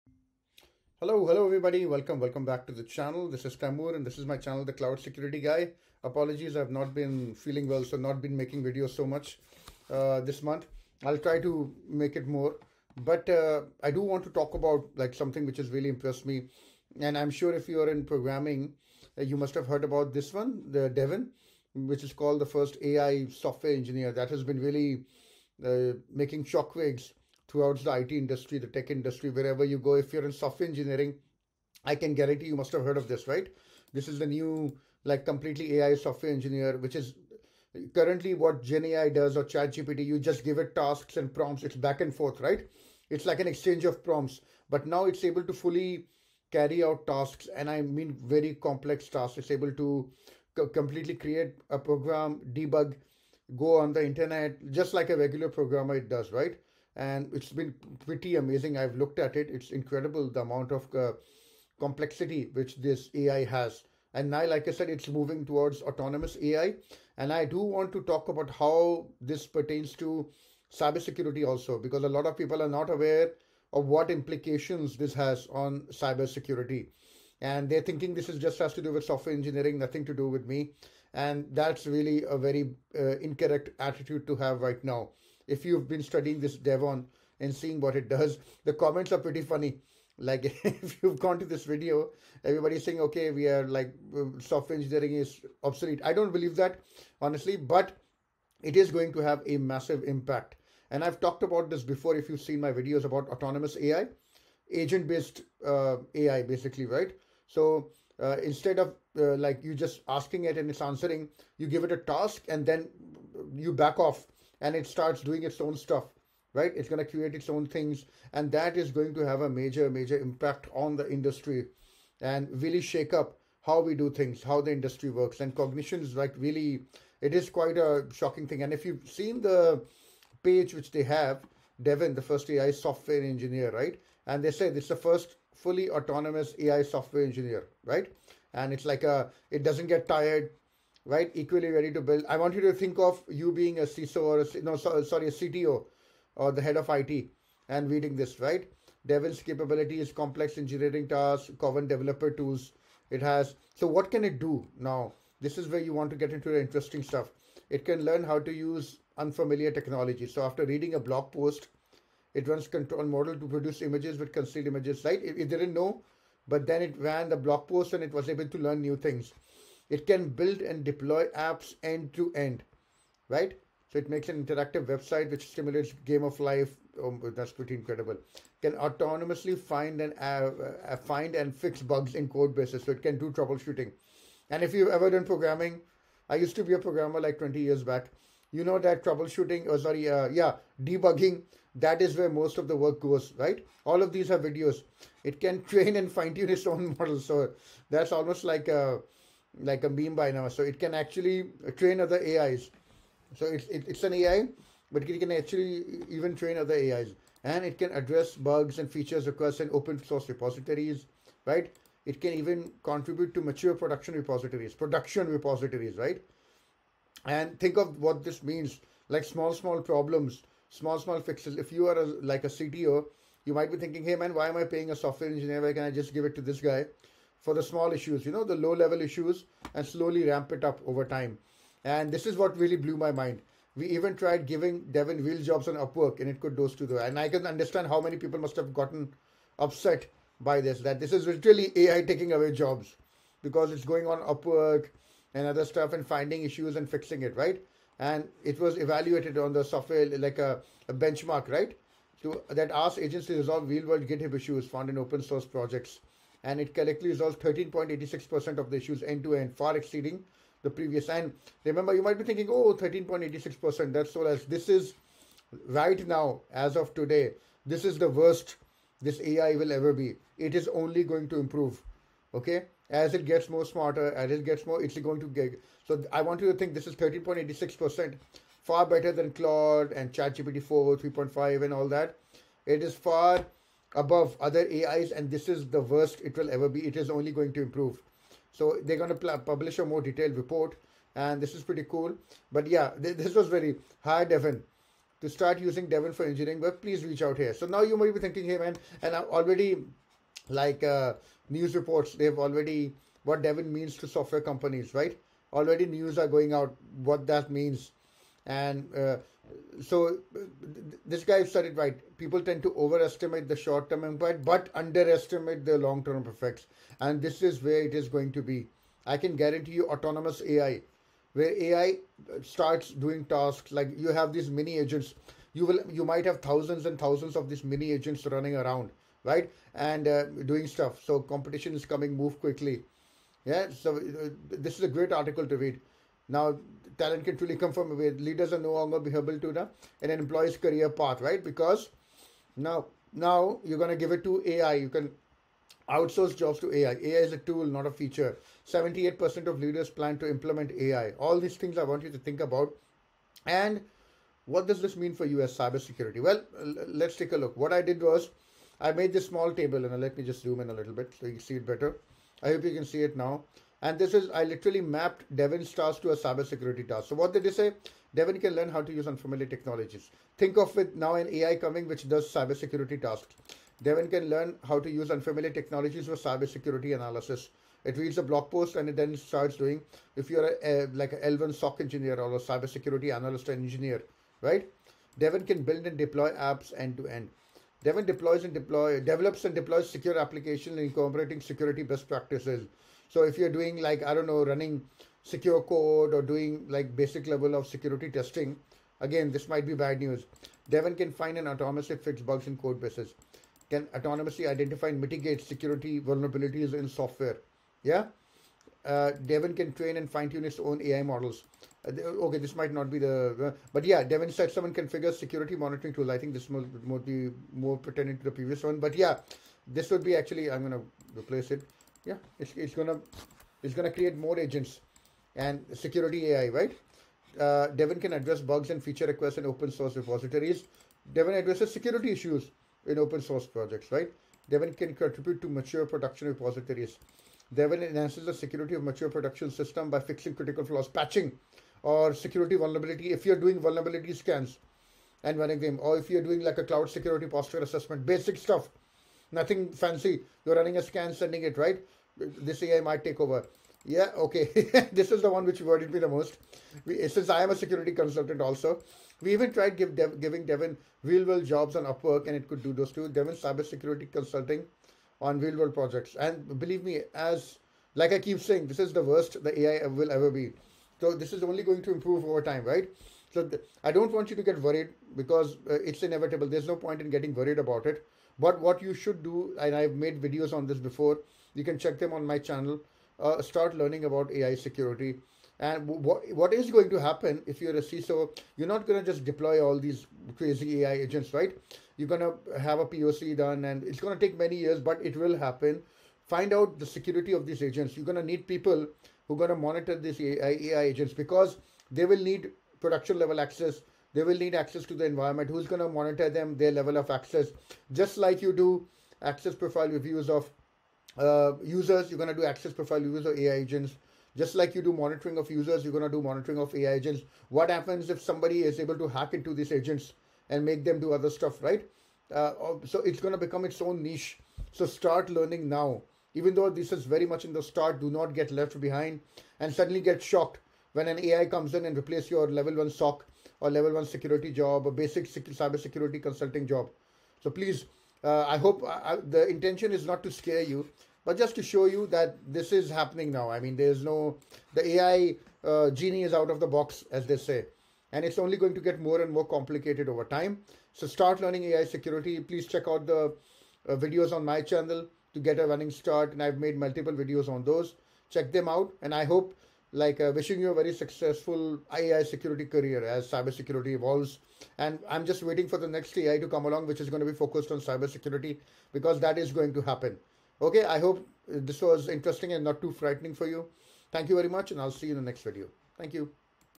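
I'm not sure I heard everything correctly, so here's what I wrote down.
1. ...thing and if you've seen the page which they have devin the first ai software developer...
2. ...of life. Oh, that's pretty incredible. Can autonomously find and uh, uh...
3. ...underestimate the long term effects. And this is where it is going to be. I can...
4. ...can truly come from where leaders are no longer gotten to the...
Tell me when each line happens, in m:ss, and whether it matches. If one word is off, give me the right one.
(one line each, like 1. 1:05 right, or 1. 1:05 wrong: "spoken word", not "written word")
1. 2:08 wrong: "engineer", not "developer"
2. 2:56 right
3. 5:14 right
4. 5:37 wrong: "beholden", not "gotten".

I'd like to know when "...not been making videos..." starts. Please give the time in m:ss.
0:07.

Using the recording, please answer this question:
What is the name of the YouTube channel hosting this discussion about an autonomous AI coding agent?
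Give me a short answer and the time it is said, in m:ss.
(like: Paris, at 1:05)
The Cloud Security Guy, at 0:04.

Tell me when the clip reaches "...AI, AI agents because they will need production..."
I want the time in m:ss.
8:20.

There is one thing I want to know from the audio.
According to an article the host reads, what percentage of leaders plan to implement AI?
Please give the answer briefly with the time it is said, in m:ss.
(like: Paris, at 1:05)
78%, at 5:48.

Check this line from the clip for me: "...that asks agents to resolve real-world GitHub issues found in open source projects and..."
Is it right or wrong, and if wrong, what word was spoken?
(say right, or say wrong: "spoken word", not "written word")
right.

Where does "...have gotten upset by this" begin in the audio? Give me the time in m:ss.
3:58.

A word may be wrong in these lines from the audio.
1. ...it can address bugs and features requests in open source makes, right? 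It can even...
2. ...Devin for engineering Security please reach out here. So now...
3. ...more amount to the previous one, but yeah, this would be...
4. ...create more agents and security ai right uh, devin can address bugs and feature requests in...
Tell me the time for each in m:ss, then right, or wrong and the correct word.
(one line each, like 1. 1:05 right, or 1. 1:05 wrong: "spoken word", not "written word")
1. 3:27 wrong: "repositories", not "makes"
2. 4:55 wrong: "But", not "Security"
3. 6:57 wrong: "pertinent", not "amount"
4. 7:03 right.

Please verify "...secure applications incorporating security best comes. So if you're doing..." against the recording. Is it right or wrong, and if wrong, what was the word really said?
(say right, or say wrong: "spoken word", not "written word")
wrong: "practices", not "comes".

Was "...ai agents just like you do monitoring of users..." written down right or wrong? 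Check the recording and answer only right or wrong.
right.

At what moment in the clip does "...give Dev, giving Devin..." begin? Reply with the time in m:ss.
7:39.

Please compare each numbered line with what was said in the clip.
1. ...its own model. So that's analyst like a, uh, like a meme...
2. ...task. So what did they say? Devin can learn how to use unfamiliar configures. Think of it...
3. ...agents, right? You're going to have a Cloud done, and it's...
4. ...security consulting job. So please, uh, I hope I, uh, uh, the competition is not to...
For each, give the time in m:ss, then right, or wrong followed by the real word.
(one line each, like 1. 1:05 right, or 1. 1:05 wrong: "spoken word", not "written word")
1. 3:16 wrong: "almost", not "analyst"
2. 6:06 wrong: "technologies", not "configures"
3. 8:10 wrong: "POC", not "Cloud"
4. 8:55 wrong: "intention", not "competition".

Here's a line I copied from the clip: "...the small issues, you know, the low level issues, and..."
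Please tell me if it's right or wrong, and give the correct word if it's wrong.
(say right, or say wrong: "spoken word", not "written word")
right.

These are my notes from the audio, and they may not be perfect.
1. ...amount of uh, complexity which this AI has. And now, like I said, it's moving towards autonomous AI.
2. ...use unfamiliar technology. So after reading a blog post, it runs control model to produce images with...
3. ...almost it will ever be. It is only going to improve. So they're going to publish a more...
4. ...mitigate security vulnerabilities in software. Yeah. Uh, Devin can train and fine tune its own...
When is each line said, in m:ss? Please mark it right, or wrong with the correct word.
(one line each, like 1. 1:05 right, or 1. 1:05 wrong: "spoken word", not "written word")
1. 1:00 right
2. 2:38 right
3. 4:45 wrong: "worst", not "almost"
4. 6:45 right.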